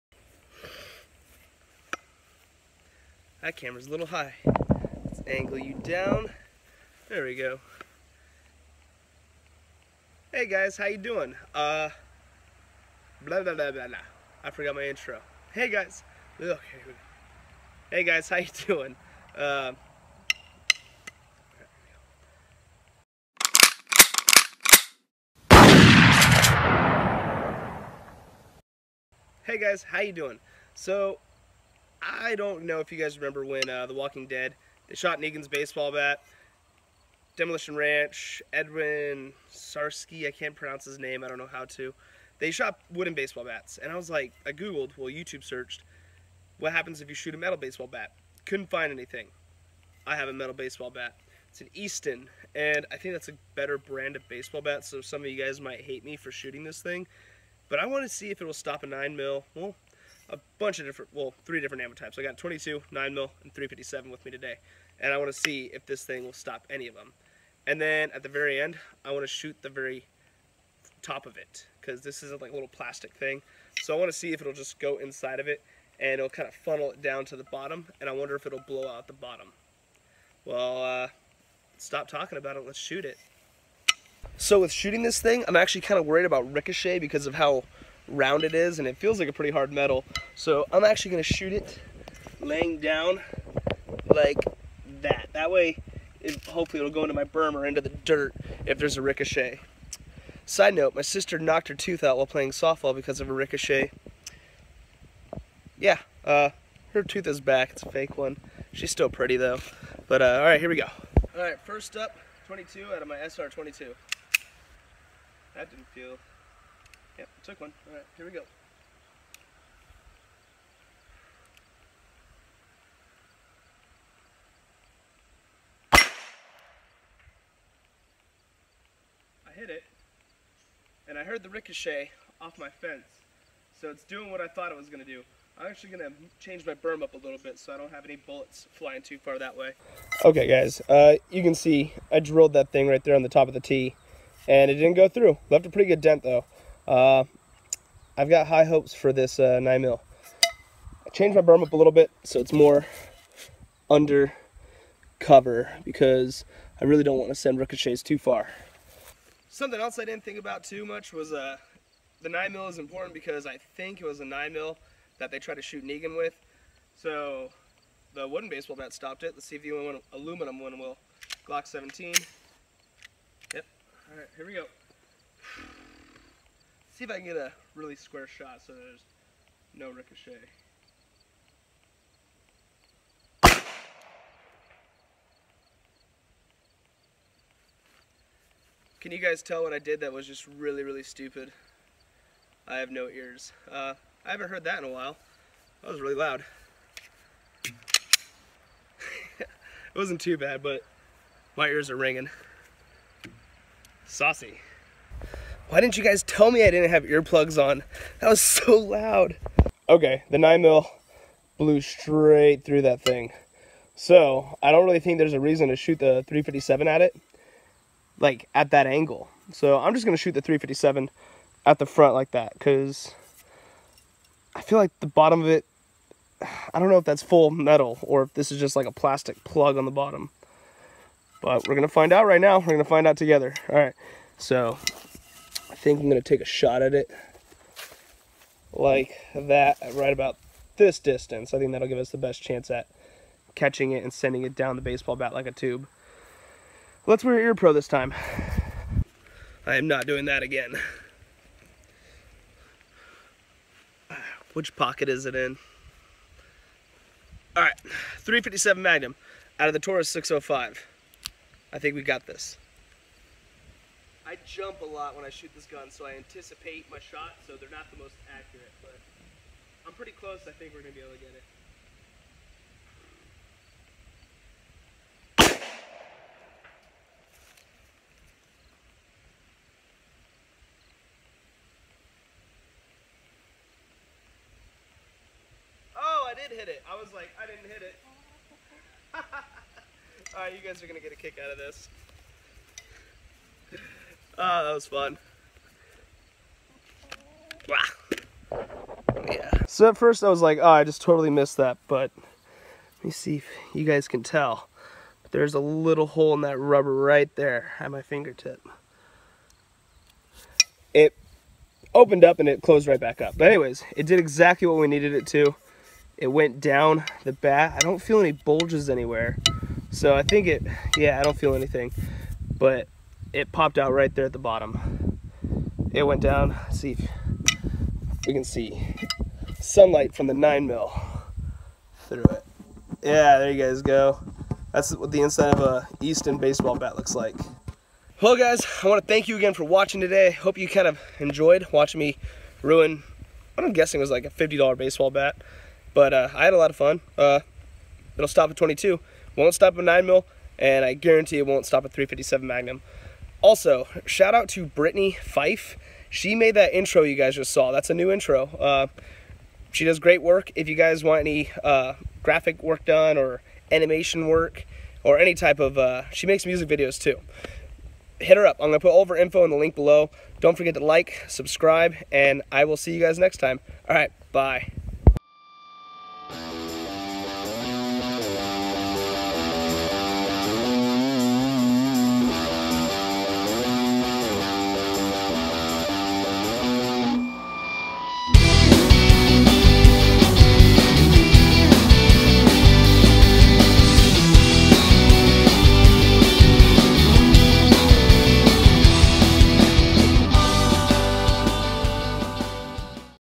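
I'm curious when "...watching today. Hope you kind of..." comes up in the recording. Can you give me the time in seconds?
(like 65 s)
339 s.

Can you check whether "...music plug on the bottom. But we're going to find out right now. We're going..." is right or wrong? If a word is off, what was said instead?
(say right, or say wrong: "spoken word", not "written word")
wrong: "plastic", not "music".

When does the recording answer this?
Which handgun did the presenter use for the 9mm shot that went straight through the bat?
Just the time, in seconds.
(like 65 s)
171 s.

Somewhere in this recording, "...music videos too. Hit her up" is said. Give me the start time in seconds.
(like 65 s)
366 s.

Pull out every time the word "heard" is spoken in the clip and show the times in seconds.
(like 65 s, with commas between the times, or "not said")
131 s, 194 s.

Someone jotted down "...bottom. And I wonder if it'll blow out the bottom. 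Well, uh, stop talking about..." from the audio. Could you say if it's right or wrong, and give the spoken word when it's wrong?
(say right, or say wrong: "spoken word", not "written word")
right.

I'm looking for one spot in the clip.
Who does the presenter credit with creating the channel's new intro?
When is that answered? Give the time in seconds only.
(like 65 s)
354 s.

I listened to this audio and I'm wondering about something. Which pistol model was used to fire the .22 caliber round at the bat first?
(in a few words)
SR22.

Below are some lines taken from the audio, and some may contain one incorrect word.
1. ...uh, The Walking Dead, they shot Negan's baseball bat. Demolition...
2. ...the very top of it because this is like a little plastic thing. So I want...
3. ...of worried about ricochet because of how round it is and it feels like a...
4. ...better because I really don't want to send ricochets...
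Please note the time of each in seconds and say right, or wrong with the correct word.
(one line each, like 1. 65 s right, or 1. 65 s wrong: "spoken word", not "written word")
1. 33 s right
2. 69 s right
3. 85 s right
4. 155 s wrong: "cover", not "better".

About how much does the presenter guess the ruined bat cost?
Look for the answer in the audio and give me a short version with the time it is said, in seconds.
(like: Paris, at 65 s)
$50, at 344 s.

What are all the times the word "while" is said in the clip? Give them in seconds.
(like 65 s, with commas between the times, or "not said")
102 s, 194 s.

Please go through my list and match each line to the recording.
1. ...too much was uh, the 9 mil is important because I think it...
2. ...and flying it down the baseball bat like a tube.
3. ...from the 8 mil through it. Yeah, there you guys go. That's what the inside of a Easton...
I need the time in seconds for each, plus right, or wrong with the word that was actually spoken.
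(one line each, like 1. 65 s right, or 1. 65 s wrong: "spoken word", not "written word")
1. 160 s right
2. 244 s wrong: "sending", not "flying"
3. 330 s wrong: "9", not "8".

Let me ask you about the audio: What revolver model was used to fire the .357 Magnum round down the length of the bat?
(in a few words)
Taurus 605.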